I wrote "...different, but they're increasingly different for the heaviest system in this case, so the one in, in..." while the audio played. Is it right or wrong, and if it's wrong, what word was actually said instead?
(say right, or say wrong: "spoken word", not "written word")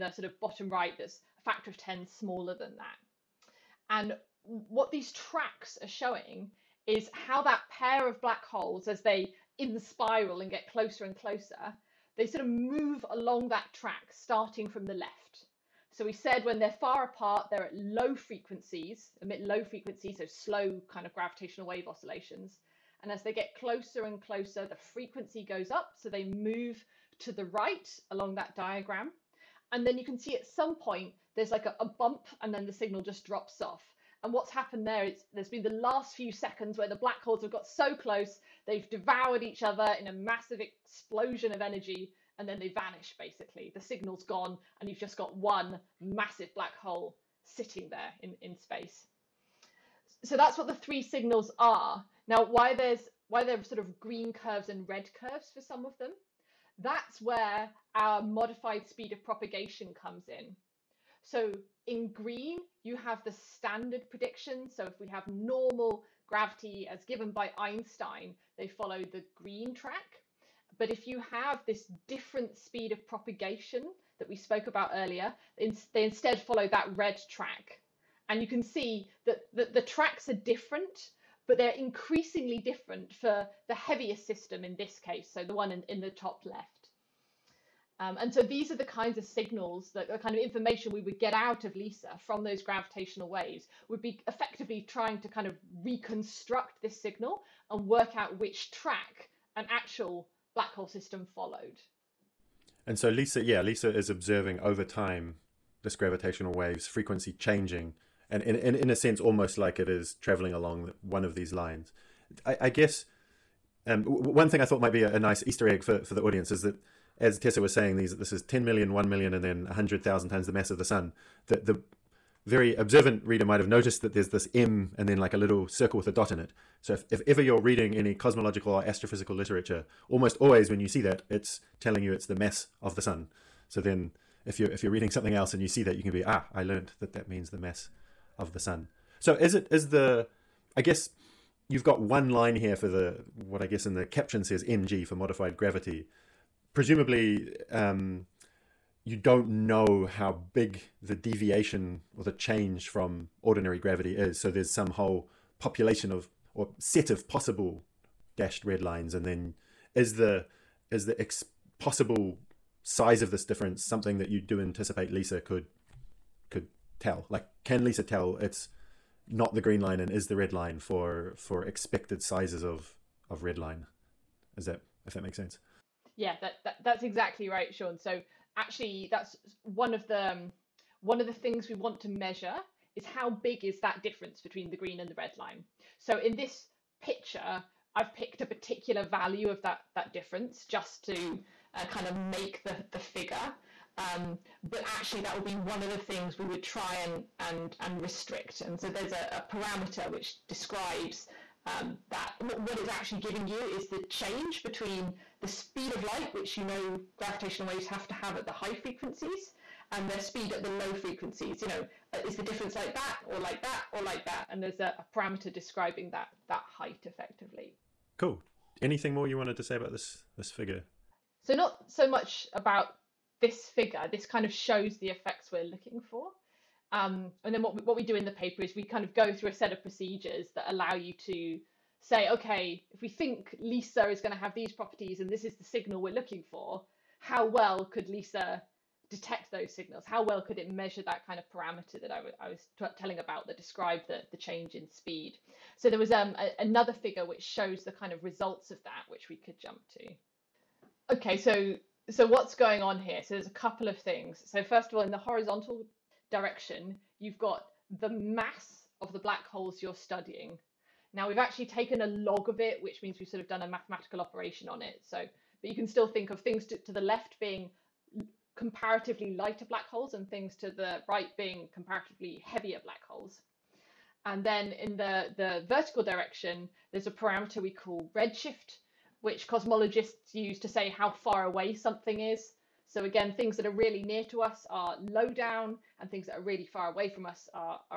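right.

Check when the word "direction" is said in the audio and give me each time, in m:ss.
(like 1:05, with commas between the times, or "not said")
4:16, 4:36.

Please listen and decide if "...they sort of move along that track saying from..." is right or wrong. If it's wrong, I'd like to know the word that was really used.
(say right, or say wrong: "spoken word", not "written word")
wrong: "starting", not "saying".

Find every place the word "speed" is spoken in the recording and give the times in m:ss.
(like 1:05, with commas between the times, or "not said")
0:58, 1:12, 3:25, 3:30, 4:04.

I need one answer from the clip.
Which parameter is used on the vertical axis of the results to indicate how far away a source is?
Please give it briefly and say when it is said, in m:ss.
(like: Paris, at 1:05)
Redshift, at 4:38.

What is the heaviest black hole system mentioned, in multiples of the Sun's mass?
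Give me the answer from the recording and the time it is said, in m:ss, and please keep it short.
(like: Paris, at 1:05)
10 million, at 1:58.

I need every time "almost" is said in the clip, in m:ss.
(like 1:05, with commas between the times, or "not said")
1:49, 2:10.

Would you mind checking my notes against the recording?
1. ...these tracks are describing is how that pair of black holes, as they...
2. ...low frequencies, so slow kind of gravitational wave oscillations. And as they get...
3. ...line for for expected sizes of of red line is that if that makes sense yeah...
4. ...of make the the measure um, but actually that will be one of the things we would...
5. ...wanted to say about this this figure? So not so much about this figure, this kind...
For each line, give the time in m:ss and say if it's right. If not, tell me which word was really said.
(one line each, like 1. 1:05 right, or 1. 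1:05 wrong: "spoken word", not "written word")
1. 0:04 wrong: "showing", not "describing"
2. 0:19 right
3. 2:50 right
4. 3:12 wrong: "figure", not "measure"
5. 3:39 right.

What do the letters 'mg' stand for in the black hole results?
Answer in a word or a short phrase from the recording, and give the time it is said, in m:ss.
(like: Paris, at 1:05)
Modified gravity, at 2:25.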